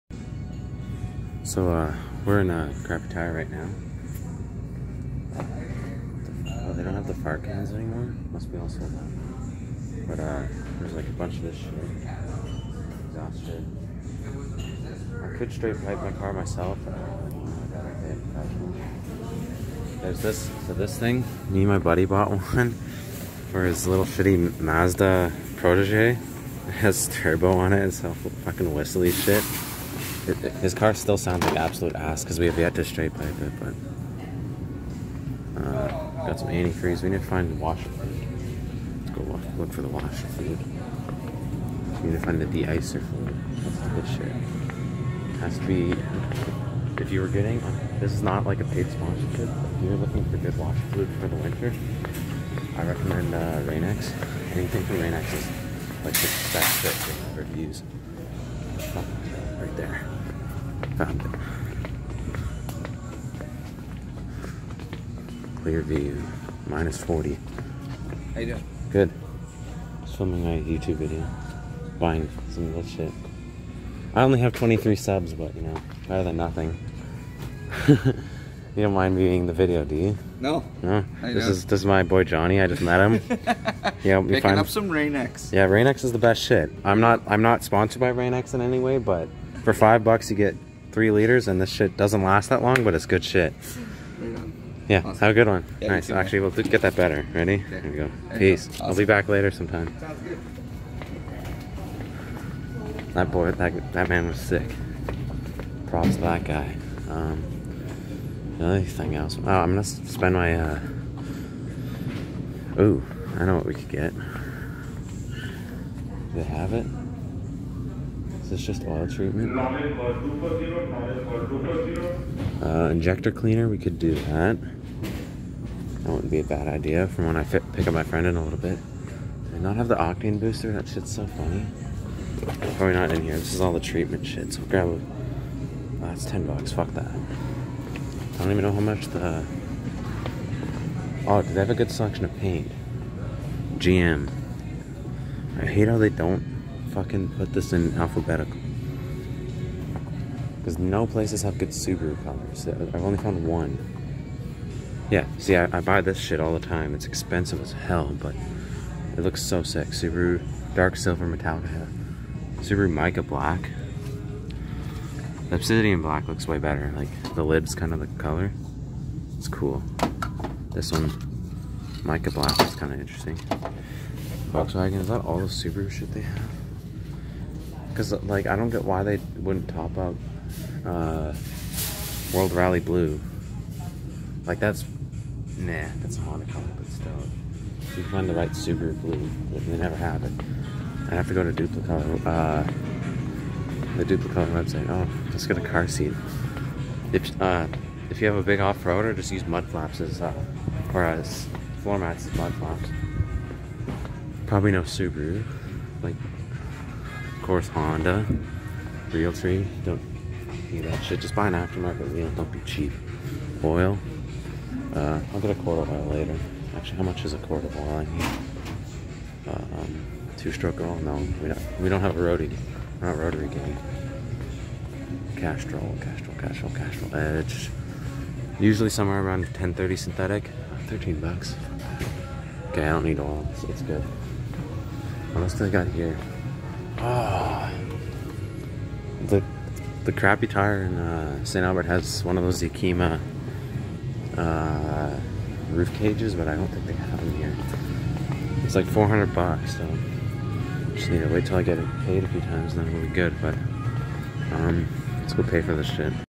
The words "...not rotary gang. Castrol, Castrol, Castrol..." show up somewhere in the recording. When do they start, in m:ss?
3:43.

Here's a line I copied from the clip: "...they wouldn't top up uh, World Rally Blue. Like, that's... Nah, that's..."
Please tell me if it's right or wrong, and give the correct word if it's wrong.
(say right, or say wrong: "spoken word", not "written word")
right.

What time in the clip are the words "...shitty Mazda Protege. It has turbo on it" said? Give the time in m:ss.
0:24.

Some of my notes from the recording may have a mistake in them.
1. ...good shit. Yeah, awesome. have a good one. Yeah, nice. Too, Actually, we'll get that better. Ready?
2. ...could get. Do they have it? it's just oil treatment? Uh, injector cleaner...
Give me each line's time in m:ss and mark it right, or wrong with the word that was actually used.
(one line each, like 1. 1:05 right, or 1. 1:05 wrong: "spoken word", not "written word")
1. 1:33 right
2. 1:53 right.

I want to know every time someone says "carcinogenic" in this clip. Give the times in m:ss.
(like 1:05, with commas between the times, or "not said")
not said.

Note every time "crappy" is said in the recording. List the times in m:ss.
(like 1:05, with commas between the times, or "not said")
0:02, 4:00.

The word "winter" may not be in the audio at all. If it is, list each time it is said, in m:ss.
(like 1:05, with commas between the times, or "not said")
0:51.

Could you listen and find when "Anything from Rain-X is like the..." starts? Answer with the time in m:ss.
0:54.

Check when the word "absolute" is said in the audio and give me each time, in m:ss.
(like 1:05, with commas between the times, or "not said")
0:31.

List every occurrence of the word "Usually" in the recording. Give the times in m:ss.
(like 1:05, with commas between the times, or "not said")
3:48.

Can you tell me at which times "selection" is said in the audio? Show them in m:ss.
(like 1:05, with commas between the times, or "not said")
2:21.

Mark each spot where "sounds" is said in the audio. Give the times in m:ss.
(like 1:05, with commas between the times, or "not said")
0:31, 1:39.